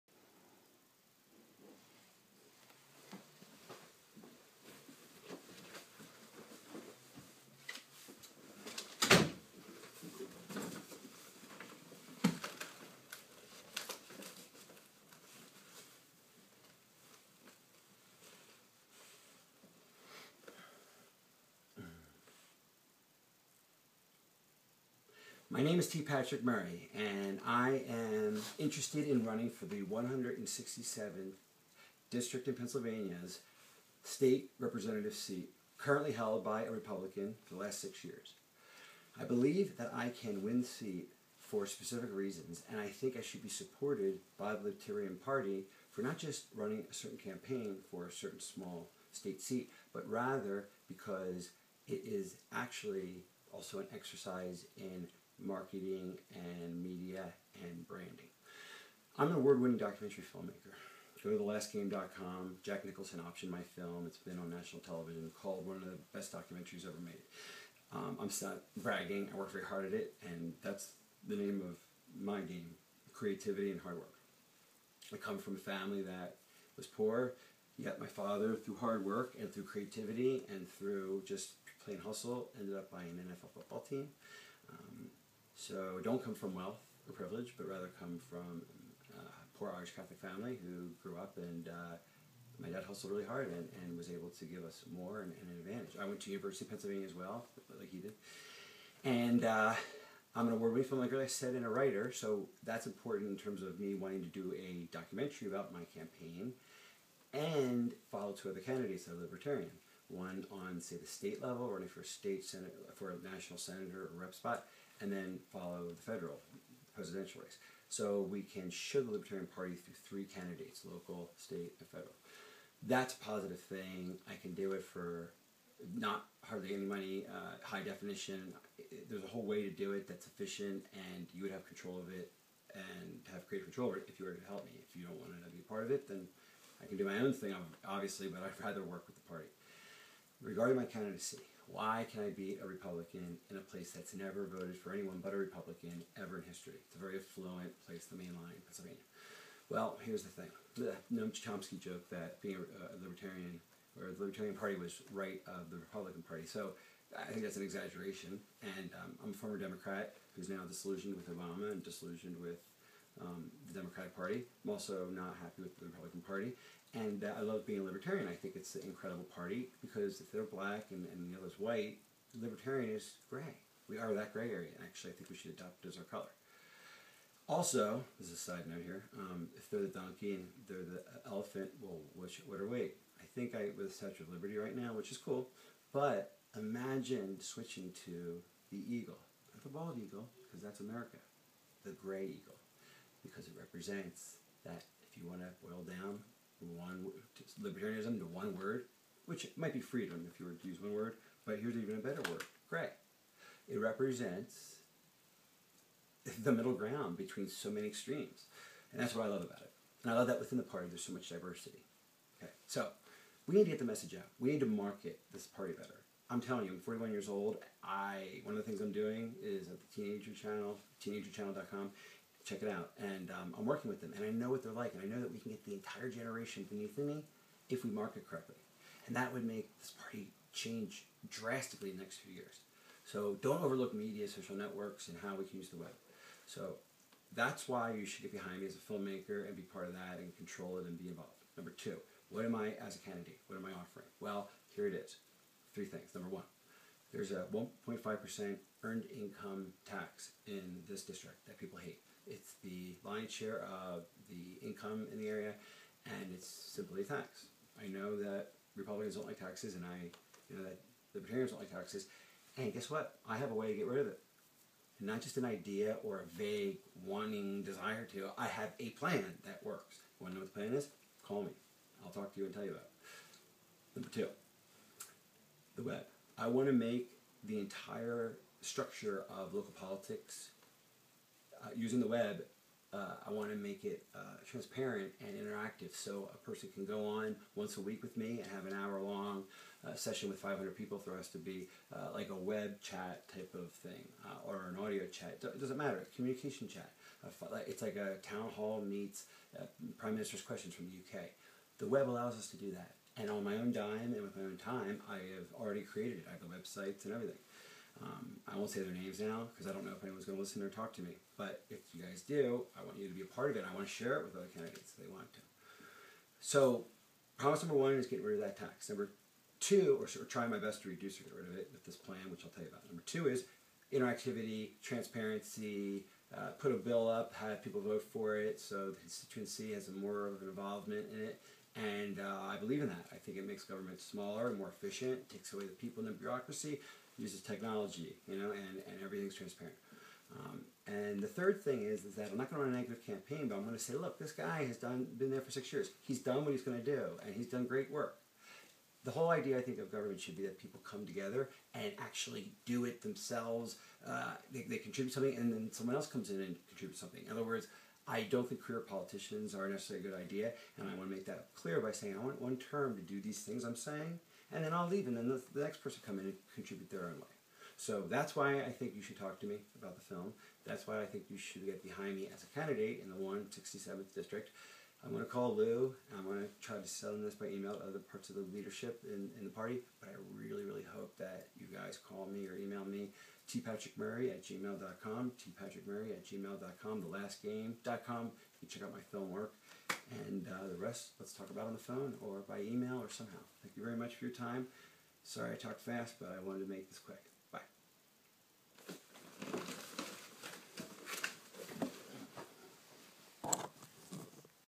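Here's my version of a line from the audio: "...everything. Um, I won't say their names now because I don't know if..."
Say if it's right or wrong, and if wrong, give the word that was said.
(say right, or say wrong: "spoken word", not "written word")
right.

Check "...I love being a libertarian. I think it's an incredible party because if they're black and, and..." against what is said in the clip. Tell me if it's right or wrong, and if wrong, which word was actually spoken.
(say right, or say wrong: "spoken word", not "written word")
right.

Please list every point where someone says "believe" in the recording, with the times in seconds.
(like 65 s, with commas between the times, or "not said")
39 s, 332 s.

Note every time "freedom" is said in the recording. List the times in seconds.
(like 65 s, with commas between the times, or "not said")
199 s.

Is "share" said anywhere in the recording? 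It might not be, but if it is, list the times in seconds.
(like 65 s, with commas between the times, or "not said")
253 s, 313 s.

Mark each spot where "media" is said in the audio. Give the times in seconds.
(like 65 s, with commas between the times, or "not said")
56 s, 233 s.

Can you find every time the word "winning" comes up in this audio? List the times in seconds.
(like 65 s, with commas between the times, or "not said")
59 s, 100 s.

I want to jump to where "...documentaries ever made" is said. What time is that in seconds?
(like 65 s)
66 s.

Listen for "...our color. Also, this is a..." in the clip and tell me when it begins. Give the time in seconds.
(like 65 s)
175 s.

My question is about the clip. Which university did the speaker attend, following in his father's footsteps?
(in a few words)
University of Pennsylvania.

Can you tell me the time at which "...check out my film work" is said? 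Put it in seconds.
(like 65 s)
388 s.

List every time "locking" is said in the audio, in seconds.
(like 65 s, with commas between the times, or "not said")
not said.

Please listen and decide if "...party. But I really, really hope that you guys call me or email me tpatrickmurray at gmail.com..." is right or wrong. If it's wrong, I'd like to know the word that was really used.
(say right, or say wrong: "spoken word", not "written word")
right.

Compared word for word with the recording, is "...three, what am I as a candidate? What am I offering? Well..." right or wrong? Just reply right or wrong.
wrong.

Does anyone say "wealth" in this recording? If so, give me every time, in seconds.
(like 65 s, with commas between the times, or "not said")
86 s.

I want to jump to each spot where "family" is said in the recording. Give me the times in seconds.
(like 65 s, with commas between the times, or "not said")
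75 s, 90 s.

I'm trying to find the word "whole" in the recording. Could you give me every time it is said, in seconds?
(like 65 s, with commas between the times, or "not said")
129 s, 349 s.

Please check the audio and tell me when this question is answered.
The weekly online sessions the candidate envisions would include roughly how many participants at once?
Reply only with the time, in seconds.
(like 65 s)
290 s.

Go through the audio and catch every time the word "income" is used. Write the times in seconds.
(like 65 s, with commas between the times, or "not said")
249 s, 254 s.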